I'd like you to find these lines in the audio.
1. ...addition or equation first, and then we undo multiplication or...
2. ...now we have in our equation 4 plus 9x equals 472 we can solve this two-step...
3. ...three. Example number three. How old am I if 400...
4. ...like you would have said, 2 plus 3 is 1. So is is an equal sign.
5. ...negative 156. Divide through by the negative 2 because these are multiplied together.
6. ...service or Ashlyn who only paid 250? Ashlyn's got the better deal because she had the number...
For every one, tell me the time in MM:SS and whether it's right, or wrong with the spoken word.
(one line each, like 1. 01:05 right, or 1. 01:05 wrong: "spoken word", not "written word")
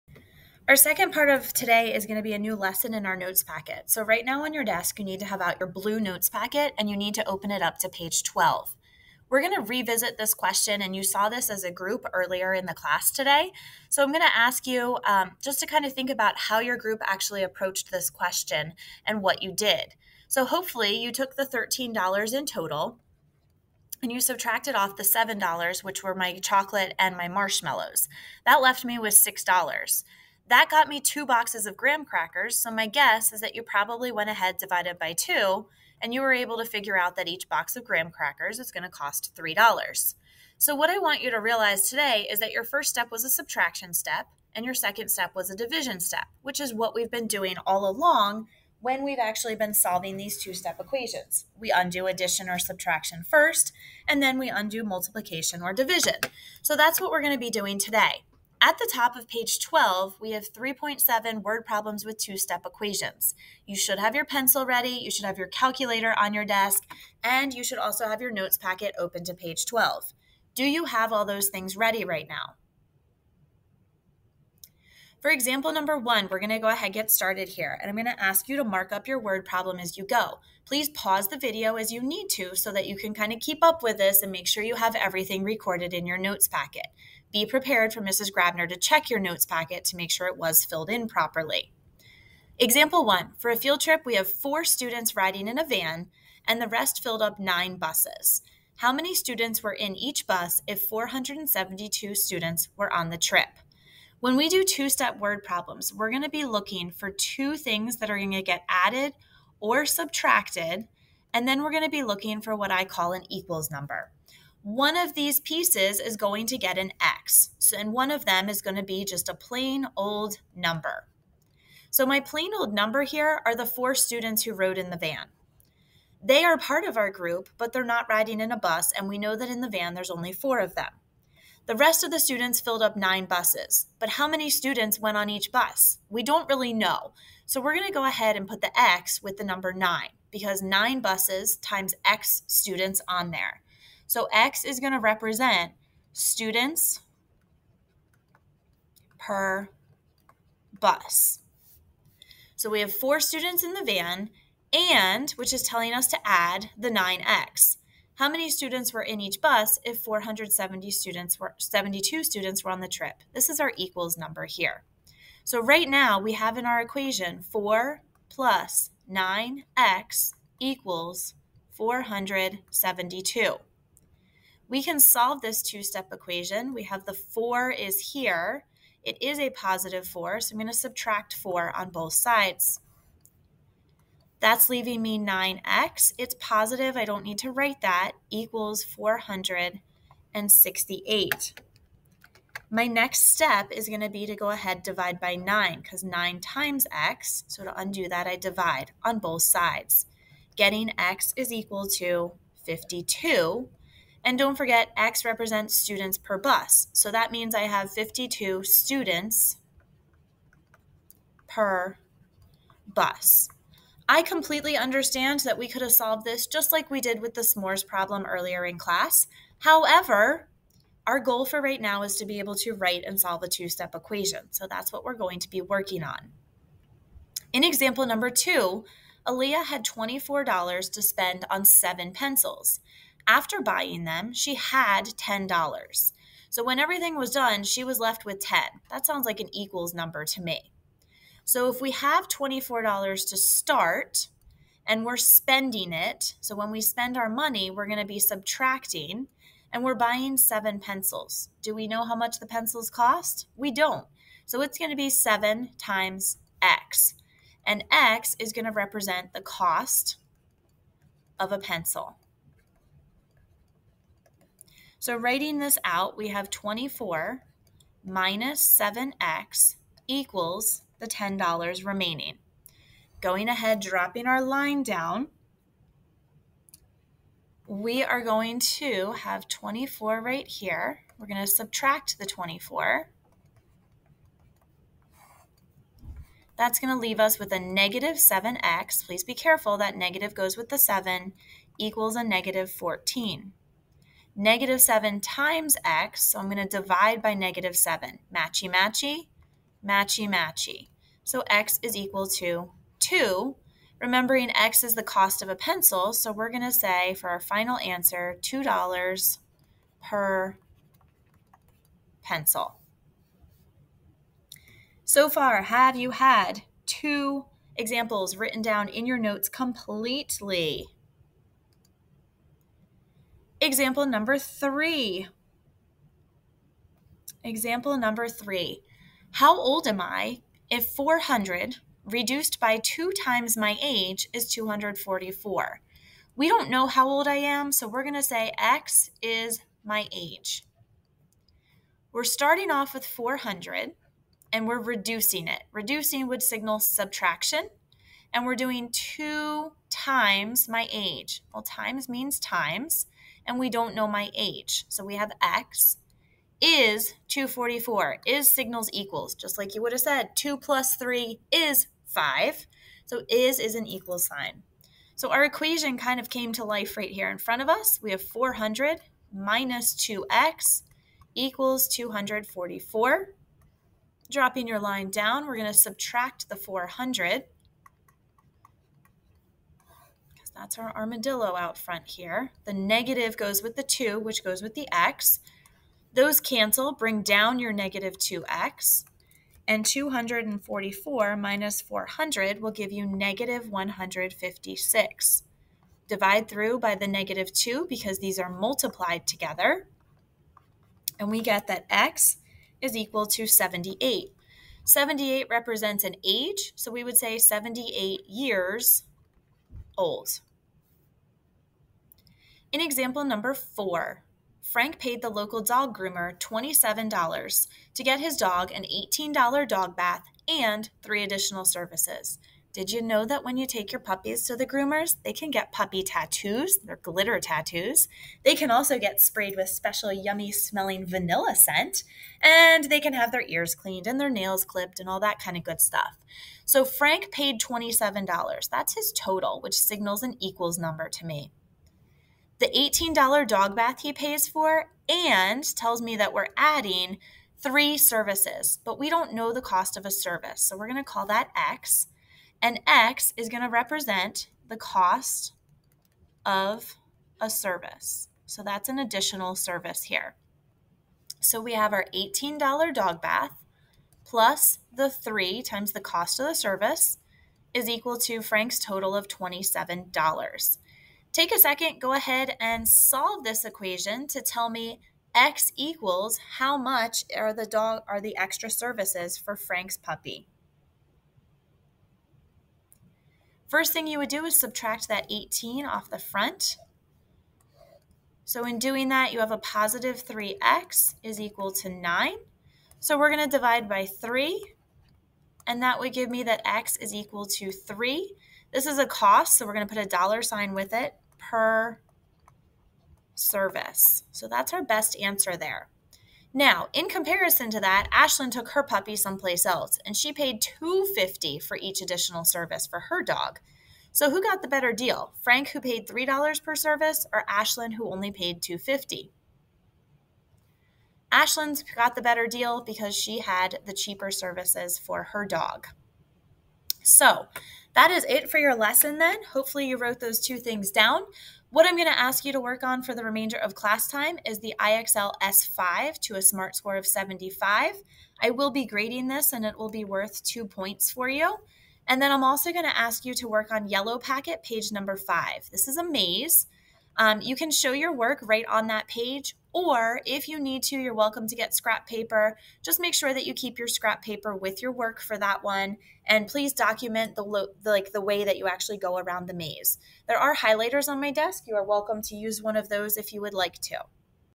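1. 00:52 wrong: "subtraction", not "equation"
2. 02:45 right
3. 05:24 right
4. 05:59 wrong: "5", not "1"
5. 06:33 right
6. 08:36 wrong: "cheaper", not "number".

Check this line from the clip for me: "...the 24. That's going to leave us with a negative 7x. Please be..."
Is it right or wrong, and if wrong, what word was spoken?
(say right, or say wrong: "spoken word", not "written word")
right.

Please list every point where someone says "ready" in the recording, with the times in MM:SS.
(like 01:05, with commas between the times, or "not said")
01:04, 01:11.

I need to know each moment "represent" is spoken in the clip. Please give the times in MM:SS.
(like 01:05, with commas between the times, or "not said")
02:24, 03:25, 04:18, 06:45, 07:33.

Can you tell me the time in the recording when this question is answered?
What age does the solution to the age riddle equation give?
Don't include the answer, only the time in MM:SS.
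06:47.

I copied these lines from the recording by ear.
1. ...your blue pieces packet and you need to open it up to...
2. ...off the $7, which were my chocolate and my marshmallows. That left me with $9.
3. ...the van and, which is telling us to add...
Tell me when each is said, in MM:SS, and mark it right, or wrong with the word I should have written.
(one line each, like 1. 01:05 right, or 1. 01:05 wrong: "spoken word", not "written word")
1. 00:05 wrong: "notes", not "pieces"
2. 00:24 wrong: "6", not "9"
3. 02:33 right.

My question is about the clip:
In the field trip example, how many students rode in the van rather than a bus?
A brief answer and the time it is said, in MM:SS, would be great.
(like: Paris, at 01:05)
4, at 01:34.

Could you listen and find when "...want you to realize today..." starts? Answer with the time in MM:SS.
00:40.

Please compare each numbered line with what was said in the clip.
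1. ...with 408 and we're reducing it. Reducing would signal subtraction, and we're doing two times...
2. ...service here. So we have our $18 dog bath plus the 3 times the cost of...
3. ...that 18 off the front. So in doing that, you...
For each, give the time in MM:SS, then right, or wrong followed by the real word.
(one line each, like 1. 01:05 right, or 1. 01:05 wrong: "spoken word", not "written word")
1. 05:42 wrong: "400", not "408"
2. 07:39 right
3. 08:05 right.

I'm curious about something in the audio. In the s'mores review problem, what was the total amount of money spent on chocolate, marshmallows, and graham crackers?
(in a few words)
$13.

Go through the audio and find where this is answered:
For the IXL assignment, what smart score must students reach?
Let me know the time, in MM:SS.
08:56.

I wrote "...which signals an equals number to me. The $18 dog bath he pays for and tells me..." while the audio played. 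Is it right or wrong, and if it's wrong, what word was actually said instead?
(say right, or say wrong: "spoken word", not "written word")
right.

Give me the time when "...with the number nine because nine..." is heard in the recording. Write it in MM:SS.
02:19.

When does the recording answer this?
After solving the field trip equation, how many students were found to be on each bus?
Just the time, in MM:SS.
03:27.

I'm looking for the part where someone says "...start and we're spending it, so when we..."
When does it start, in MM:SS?
04:03.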